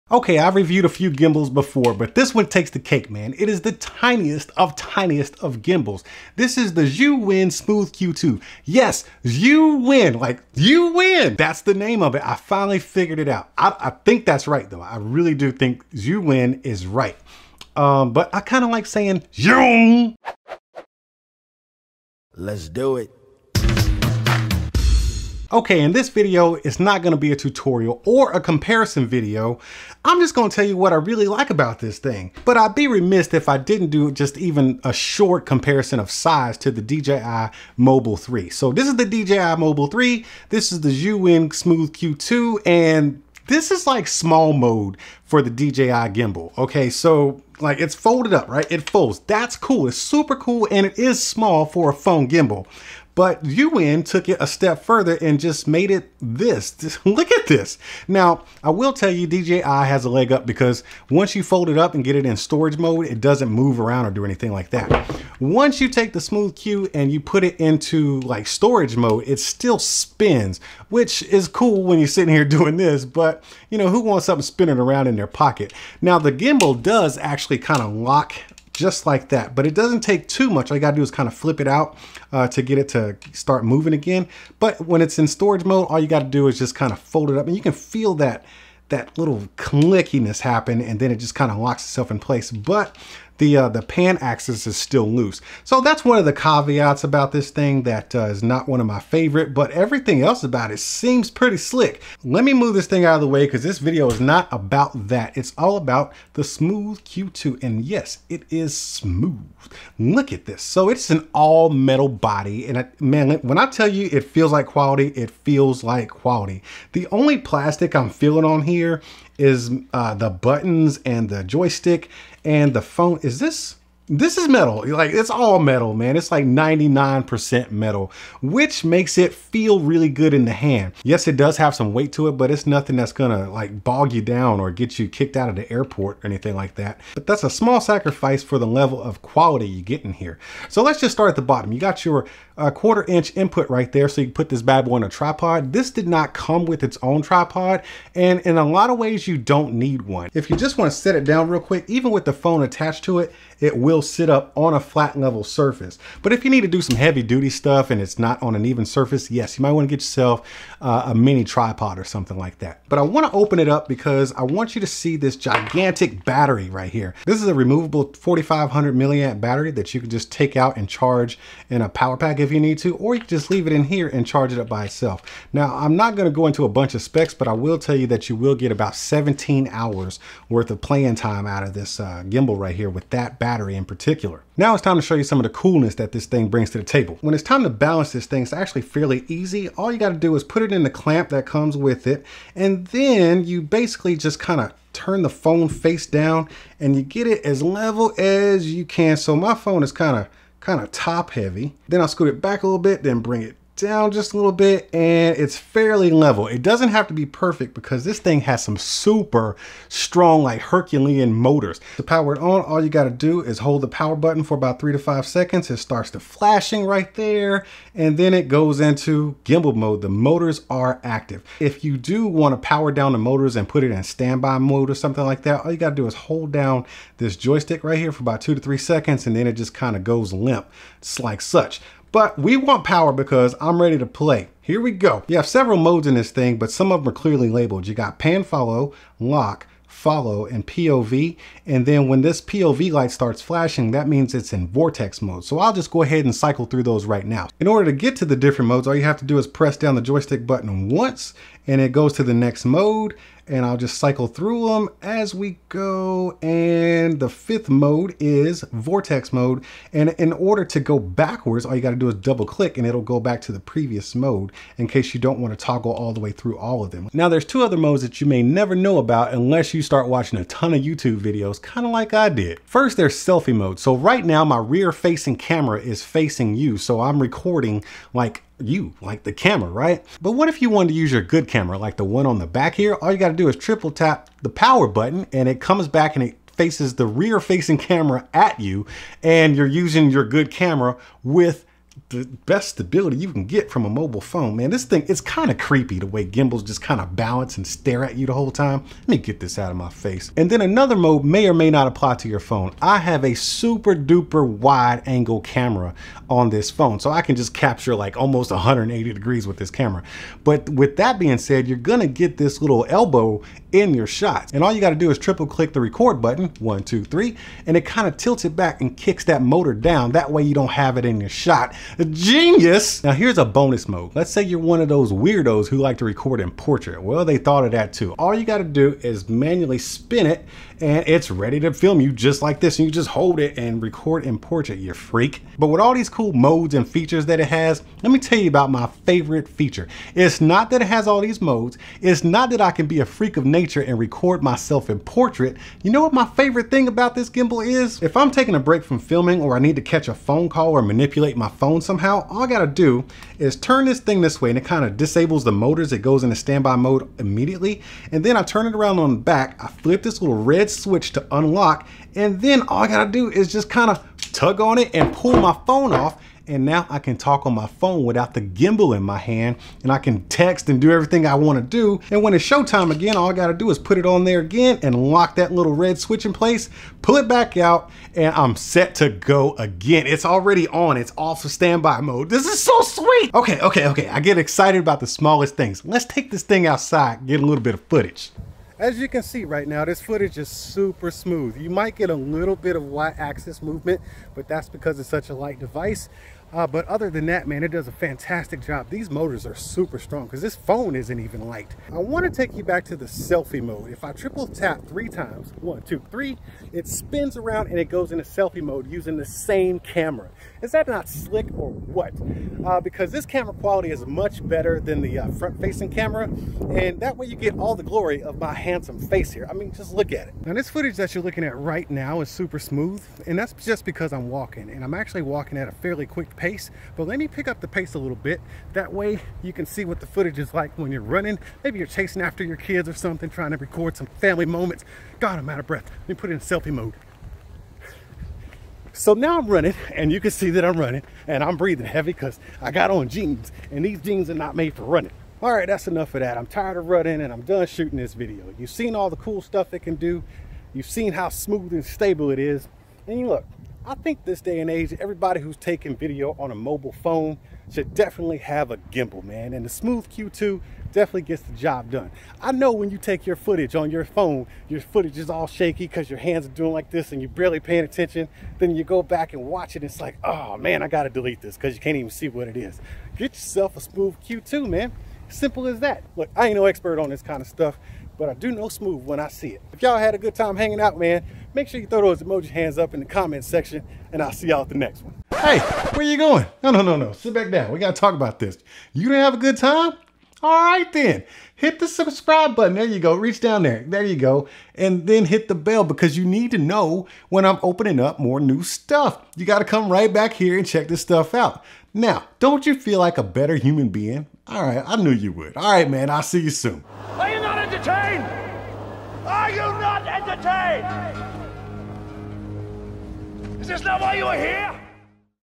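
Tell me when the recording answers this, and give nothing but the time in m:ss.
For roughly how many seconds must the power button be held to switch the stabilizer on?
3:34.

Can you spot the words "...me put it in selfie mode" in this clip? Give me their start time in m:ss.
7:16.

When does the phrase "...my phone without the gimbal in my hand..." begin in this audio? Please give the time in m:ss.
6:07.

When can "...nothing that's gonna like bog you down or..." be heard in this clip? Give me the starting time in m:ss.
2:12.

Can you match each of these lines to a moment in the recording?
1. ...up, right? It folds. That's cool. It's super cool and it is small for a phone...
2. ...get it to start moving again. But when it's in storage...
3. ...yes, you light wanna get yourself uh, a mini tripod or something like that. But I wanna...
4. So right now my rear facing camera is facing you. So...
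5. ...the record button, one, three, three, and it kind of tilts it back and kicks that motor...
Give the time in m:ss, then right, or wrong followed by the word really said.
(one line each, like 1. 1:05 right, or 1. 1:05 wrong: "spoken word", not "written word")
1. 0:48 right
2. 1:22 right
3. 2:39 wrong: "might", not "light"
4. 4:33 right
5. 5:15 wrong: "two", not "three".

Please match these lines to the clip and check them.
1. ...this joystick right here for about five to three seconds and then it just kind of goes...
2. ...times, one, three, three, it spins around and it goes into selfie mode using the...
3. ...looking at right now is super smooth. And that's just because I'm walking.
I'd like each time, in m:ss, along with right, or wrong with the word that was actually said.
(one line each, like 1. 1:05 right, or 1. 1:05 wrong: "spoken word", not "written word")
1. 3:47 wrong: "two", not "five"
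2. 6:45 wrong: "two", not "three"
3. 7:01 right.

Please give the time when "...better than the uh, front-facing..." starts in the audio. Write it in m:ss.
6:54.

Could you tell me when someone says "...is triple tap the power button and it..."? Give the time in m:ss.
4:43.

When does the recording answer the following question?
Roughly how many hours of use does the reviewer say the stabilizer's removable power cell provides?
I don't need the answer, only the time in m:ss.
2:58.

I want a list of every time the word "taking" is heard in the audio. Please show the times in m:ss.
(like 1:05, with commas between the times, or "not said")
5:48, 7:35.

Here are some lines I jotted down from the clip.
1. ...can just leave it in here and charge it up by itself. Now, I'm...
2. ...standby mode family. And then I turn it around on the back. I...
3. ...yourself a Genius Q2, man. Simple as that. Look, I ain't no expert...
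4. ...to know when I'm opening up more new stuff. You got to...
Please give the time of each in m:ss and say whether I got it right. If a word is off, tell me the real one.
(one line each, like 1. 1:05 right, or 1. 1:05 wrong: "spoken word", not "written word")
1. 2:53 right
2. 5:56 wrong: "immediately", not "family"
3. 7:53 wrong: "Smooth", not "Genius"
4. 8:16 right.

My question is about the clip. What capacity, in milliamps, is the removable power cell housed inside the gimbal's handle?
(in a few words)
4500.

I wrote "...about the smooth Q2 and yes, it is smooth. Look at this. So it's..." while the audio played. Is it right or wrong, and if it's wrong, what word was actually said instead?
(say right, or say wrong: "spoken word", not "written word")
right.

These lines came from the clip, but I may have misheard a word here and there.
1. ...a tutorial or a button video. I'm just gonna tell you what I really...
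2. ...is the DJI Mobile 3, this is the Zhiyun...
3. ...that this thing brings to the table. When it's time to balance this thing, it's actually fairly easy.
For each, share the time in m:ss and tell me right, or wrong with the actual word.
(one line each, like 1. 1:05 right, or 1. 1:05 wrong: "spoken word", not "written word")
1. 0:27 wrong: "comparison", not "button"
2. 0:38 right
3. 3:05 right.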